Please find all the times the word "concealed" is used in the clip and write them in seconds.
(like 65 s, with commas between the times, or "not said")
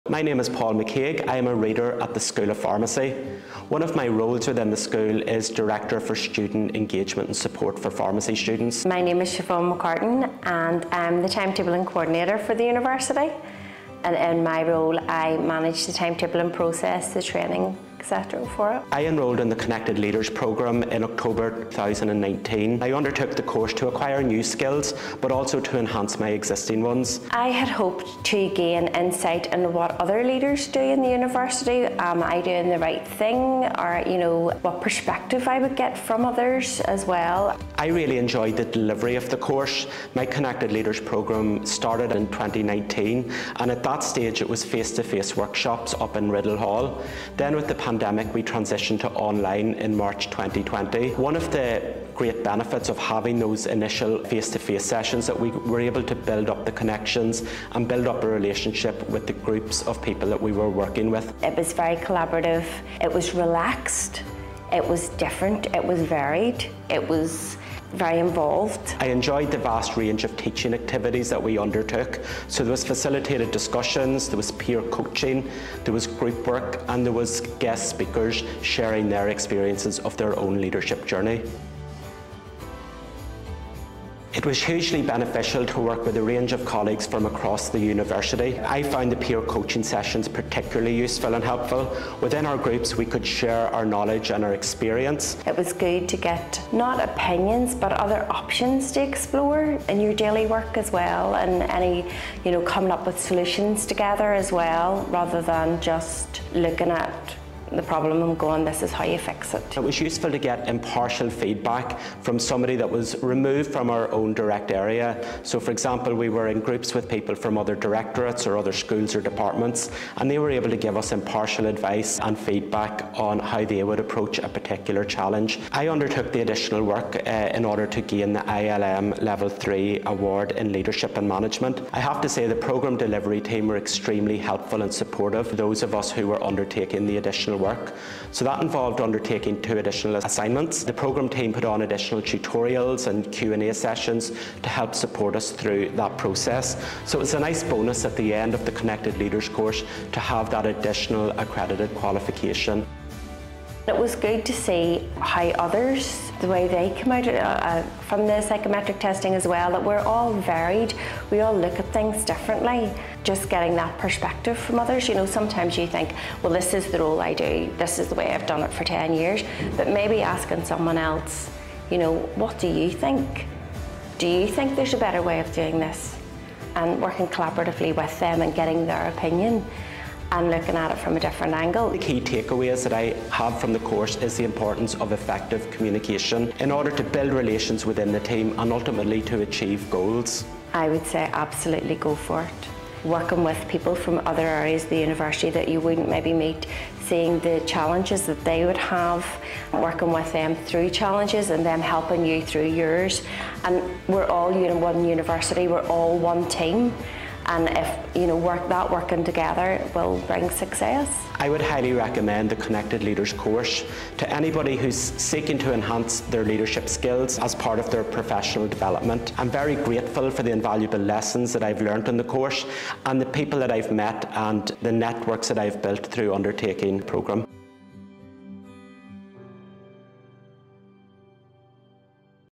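not said.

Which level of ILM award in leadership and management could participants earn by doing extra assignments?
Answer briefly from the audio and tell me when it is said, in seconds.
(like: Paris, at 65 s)
Level 3, at 129 s.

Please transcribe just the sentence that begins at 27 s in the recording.
I had hoped to gain insight into what other leaders do in the university.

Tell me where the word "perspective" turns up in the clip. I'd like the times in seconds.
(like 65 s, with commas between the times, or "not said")
34 s, 163 s.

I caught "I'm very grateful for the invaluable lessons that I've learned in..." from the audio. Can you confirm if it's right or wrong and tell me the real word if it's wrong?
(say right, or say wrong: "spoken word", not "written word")
right.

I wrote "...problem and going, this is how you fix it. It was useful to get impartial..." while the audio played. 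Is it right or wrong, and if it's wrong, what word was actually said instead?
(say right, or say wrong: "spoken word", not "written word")
right.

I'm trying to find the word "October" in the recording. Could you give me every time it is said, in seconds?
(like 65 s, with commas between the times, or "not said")
21 s.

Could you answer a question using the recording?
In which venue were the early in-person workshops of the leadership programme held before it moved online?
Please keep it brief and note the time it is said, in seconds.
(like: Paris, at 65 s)
Riddel Hall, at 46 s.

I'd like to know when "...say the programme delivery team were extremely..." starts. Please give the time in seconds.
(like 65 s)
132 s.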